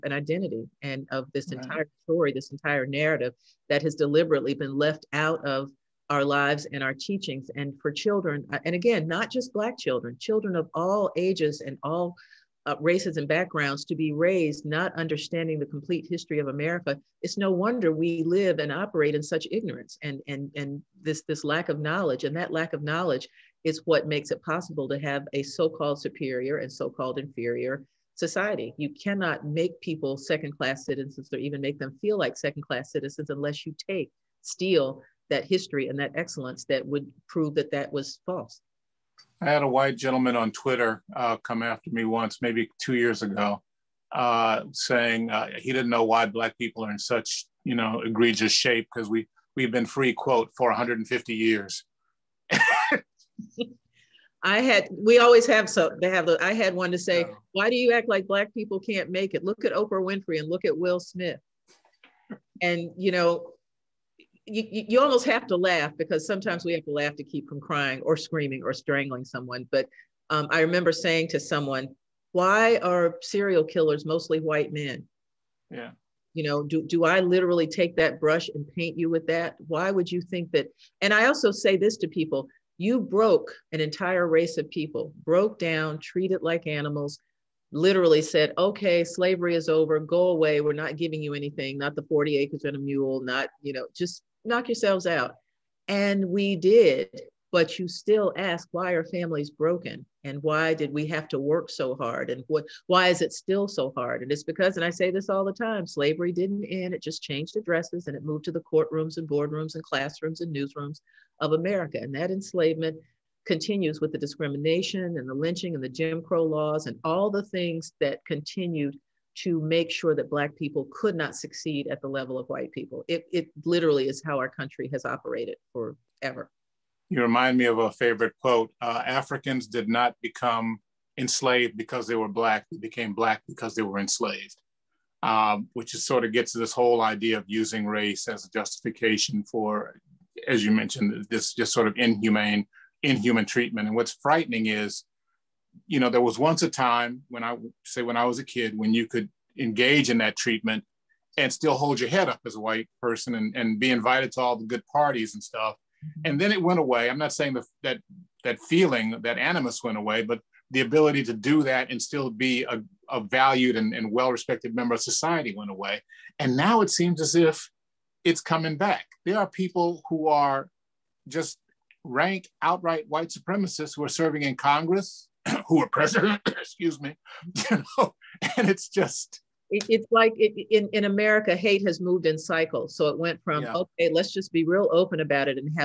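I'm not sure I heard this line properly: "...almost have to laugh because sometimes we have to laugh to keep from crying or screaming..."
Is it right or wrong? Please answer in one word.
right.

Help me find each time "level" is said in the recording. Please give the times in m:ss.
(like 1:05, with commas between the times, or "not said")
2:02.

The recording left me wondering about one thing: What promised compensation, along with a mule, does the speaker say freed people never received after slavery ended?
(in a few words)
40 acres.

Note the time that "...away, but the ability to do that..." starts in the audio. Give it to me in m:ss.
2:39.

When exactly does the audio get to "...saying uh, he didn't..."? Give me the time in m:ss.
0:44.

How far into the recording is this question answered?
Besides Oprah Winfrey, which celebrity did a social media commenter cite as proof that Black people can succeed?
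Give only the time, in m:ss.
1:00.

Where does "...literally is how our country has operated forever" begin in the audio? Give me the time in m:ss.
2:03.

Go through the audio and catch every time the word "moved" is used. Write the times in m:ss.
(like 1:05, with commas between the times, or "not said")
1:48, 3:01.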